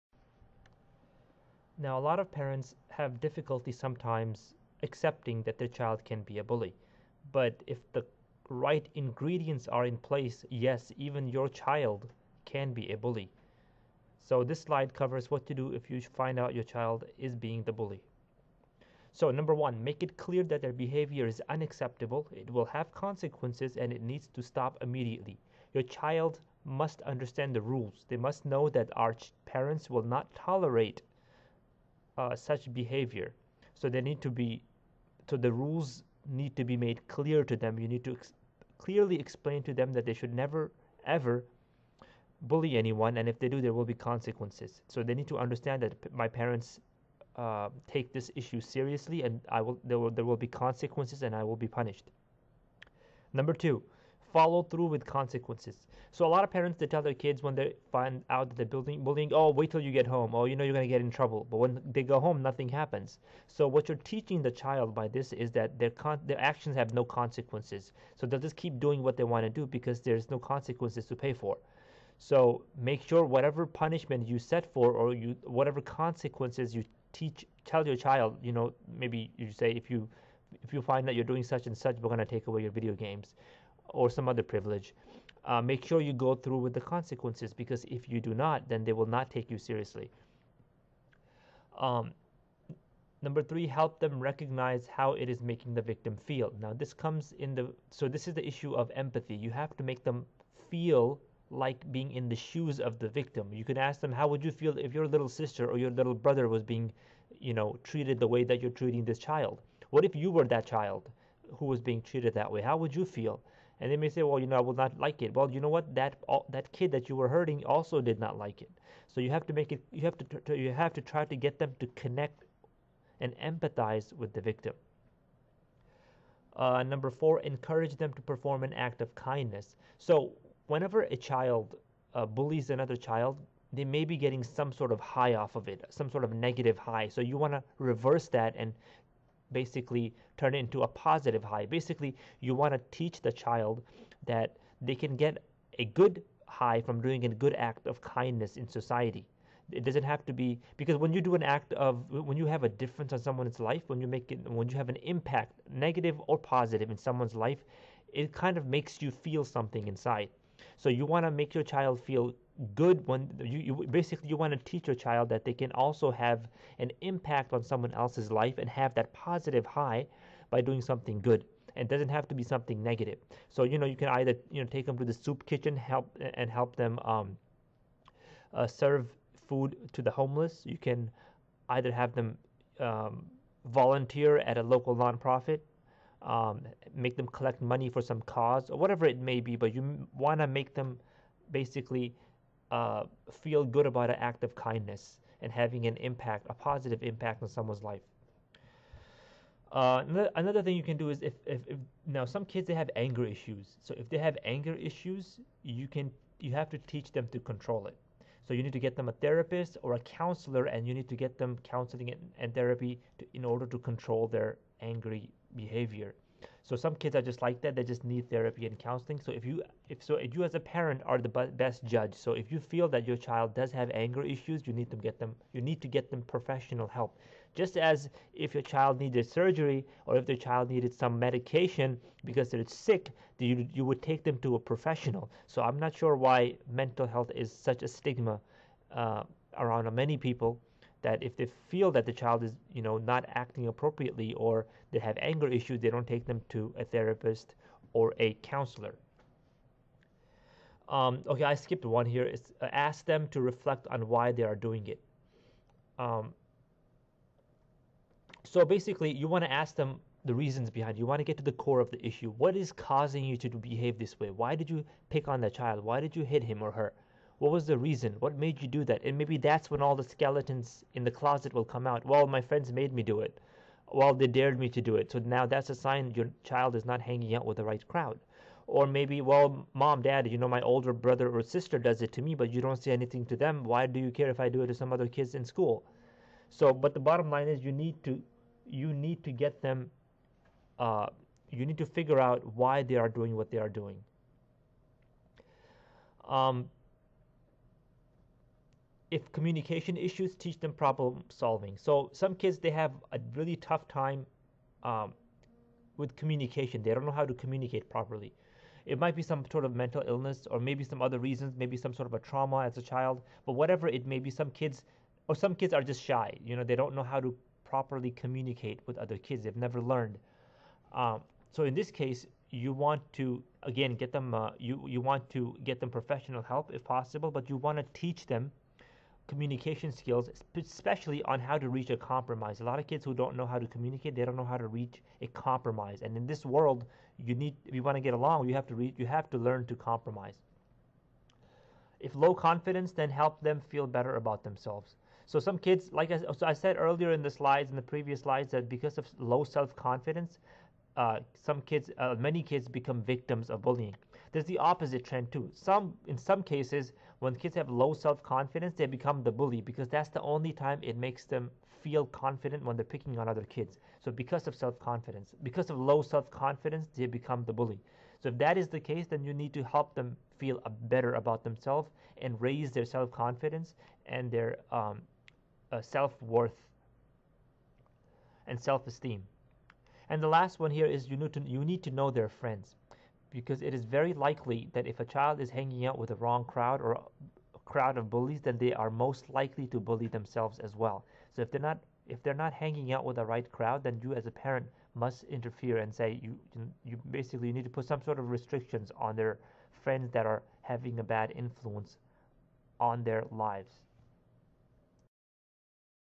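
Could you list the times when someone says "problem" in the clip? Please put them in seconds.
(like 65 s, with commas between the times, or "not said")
300 s.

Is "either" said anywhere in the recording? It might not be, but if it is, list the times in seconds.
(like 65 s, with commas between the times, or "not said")
174 s, 181 s.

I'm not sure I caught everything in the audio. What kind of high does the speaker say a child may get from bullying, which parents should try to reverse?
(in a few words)
negative high.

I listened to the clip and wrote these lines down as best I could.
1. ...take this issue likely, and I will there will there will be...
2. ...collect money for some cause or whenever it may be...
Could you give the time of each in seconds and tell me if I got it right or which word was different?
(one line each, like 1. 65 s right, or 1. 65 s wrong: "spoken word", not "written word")
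1. 47 s wrong: "seriously", not "likely"
2. 187 s wrong: "whatever", not "whenever".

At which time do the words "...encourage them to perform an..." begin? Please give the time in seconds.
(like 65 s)
127 s.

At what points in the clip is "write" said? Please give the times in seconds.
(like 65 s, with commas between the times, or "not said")
not said.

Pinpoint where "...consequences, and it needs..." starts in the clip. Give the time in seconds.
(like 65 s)
22 s.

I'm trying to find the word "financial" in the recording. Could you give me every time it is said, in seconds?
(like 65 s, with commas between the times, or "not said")
not said.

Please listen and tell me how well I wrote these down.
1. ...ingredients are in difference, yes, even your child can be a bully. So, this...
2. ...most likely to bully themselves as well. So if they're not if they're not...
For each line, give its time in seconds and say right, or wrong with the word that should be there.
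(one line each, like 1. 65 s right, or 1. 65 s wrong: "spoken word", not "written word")
1. 8 s wrong: "place", not "difference"
2. 388 s right.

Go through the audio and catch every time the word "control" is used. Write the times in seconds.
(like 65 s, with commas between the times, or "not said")
207 s, 213 s.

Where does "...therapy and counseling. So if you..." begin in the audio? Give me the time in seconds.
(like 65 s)
218 s.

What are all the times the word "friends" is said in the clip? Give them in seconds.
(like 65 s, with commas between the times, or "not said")
272 s, 382 s, 399 s.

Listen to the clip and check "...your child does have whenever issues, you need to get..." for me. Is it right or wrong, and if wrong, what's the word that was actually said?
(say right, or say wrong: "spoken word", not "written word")
wrong: "anger", not "whenever".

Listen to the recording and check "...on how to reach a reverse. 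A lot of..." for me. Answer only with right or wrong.
wrong.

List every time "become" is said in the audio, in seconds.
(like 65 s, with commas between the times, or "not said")
352 s, 358 s, 367 s.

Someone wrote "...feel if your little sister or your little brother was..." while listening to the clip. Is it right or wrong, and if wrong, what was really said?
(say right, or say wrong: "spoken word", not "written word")
right.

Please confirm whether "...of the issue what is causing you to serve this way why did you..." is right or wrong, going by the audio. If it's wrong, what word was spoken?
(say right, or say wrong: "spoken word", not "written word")
wrong: "behave", not "serve".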